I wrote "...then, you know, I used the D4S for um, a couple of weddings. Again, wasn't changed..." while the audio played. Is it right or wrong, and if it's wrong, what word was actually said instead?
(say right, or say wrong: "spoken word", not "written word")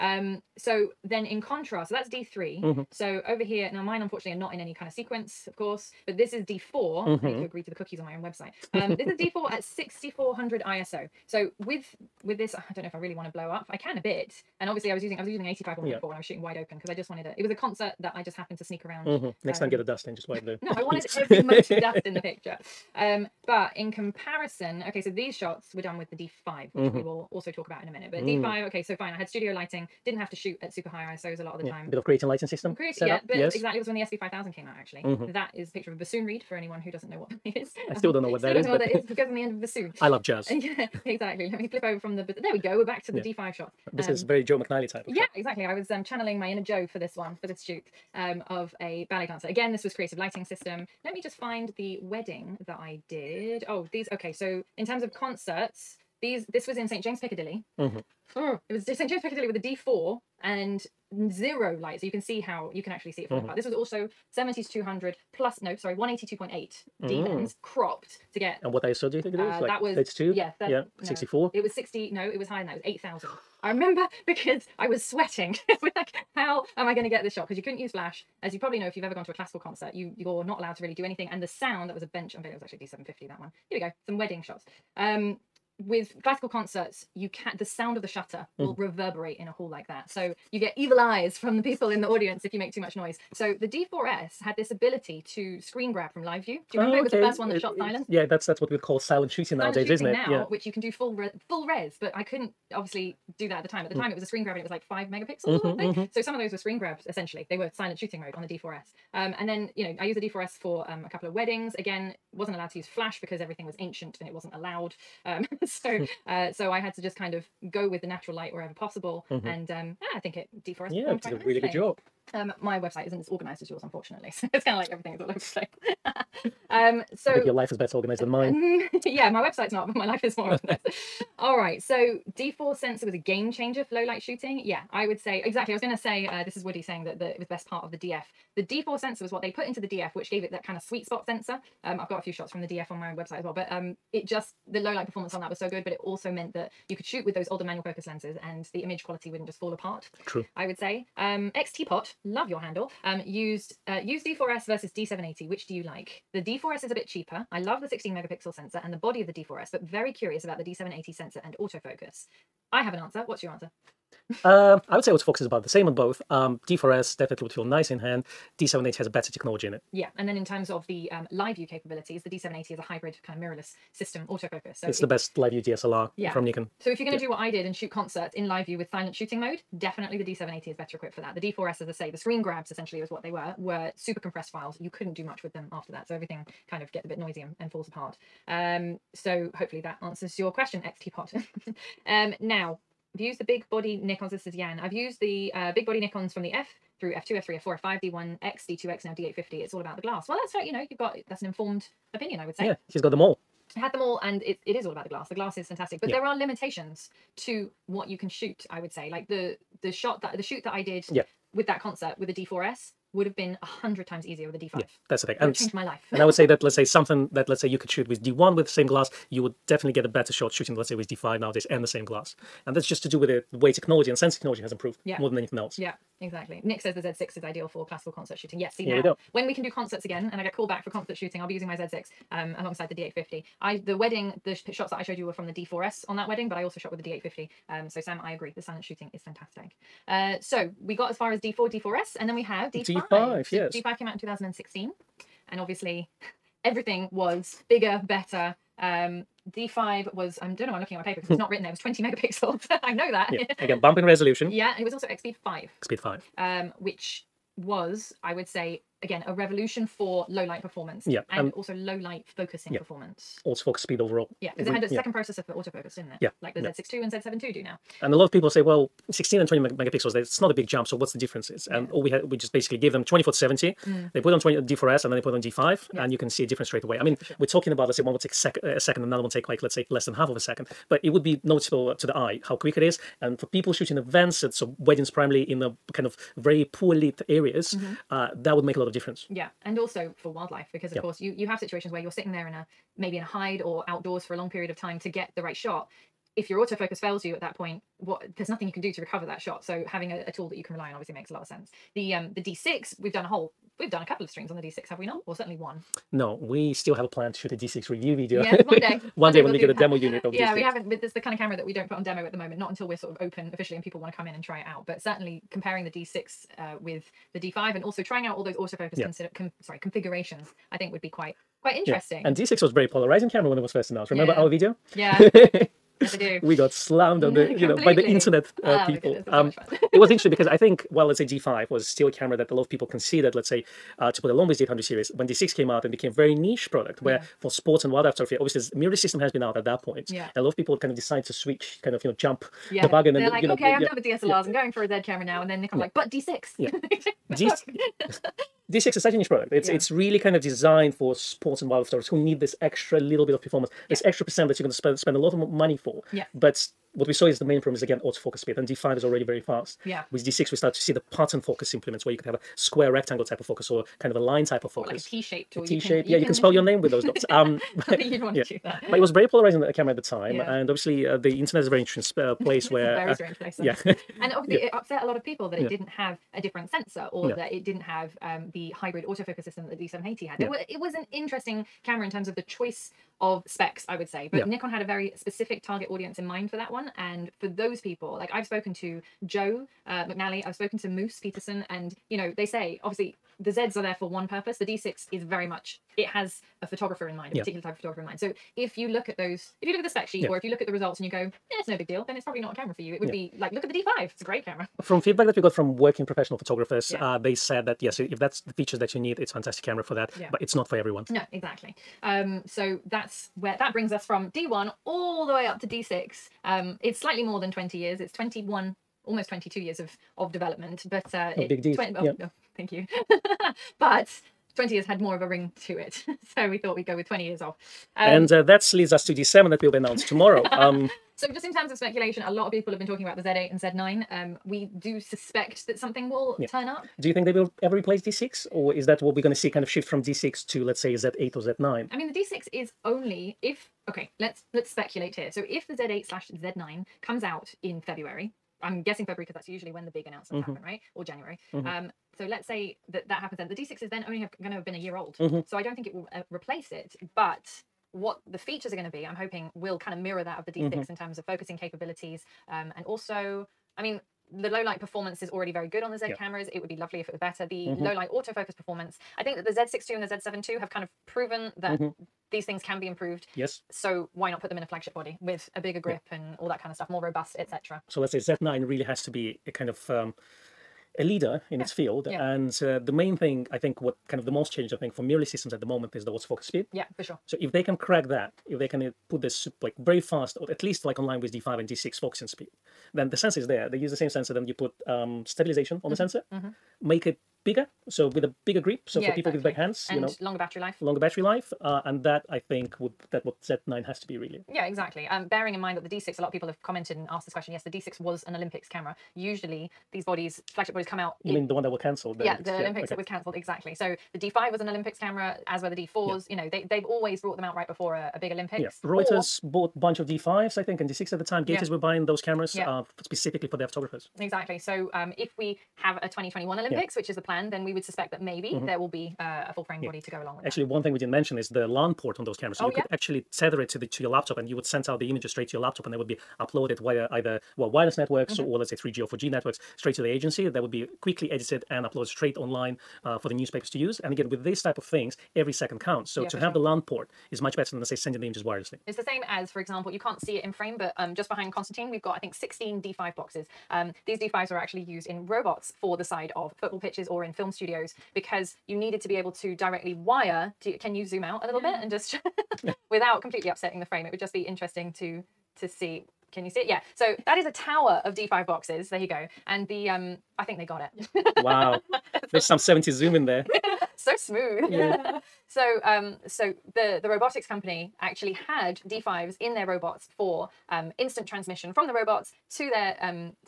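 wrong: "allowed", not "changed".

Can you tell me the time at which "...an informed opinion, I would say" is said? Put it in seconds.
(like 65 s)
201 s.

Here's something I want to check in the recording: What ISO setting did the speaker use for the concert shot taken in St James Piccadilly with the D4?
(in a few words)
8000.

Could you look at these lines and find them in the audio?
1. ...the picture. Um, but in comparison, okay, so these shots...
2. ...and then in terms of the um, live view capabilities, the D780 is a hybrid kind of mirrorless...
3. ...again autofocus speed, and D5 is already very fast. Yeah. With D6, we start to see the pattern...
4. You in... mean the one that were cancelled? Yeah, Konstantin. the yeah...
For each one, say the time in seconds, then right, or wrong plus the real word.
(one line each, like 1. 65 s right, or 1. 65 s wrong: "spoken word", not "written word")
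1. 22 s right
2. 170 s right
3. 357 s right
4. 511 s wrong: "Olympics", not "Konstantin".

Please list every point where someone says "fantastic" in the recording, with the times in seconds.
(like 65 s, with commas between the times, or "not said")
205 s, 239 s, 409 s.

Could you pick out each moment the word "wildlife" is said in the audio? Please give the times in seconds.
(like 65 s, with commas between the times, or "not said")
290 s, 337 s, 351 s.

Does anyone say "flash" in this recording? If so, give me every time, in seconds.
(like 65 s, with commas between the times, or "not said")
77 s, 112 s.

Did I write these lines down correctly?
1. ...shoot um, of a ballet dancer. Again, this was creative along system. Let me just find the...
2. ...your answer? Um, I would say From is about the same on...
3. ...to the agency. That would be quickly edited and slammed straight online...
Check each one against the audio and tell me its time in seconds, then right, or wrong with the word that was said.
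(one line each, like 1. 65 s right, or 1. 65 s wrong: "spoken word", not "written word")
1. 47 s wrong: "lighting", not "along"
2. 163 s wrong: "Autofocus", not "From"
3. 539 s wrong: "uploaded", not "slammed".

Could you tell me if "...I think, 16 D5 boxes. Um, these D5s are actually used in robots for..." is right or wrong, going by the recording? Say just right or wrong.
right.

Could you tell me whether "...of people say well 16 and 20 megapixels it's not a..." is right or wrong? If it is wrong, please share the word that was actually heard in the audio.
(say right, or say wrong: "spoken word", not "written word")
right.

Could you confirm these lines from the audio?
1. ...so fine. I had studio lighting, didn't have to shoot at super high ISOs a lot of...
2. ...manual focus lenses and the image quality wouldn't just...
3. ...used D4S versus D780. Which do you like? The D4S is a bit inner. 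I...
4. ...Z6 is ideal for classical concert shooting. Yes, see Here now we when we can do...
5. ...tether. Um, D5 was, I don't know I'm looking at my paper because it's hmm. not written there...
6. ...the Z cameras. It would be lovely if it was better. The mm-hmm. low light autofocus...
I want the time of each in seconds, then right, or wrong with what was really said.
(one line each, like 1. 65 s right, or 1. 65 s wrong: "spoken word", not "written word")
1. 28 s right
2. 147 s right
3. 154 s wrong: "cheaper", not "inner"
4. 226 s right
5. 248 s wrong: "better", not "tether"
6. 465 s right.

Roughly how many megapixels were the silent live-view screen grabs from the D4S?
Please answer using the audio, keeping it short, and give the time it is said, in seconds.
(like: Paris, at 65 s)
5, at 104 s.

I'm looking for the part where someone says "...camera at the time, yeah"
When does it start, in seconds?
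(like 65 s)
369 s.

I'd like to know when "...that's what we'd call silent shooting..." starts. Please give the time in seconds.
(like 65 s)
98 s.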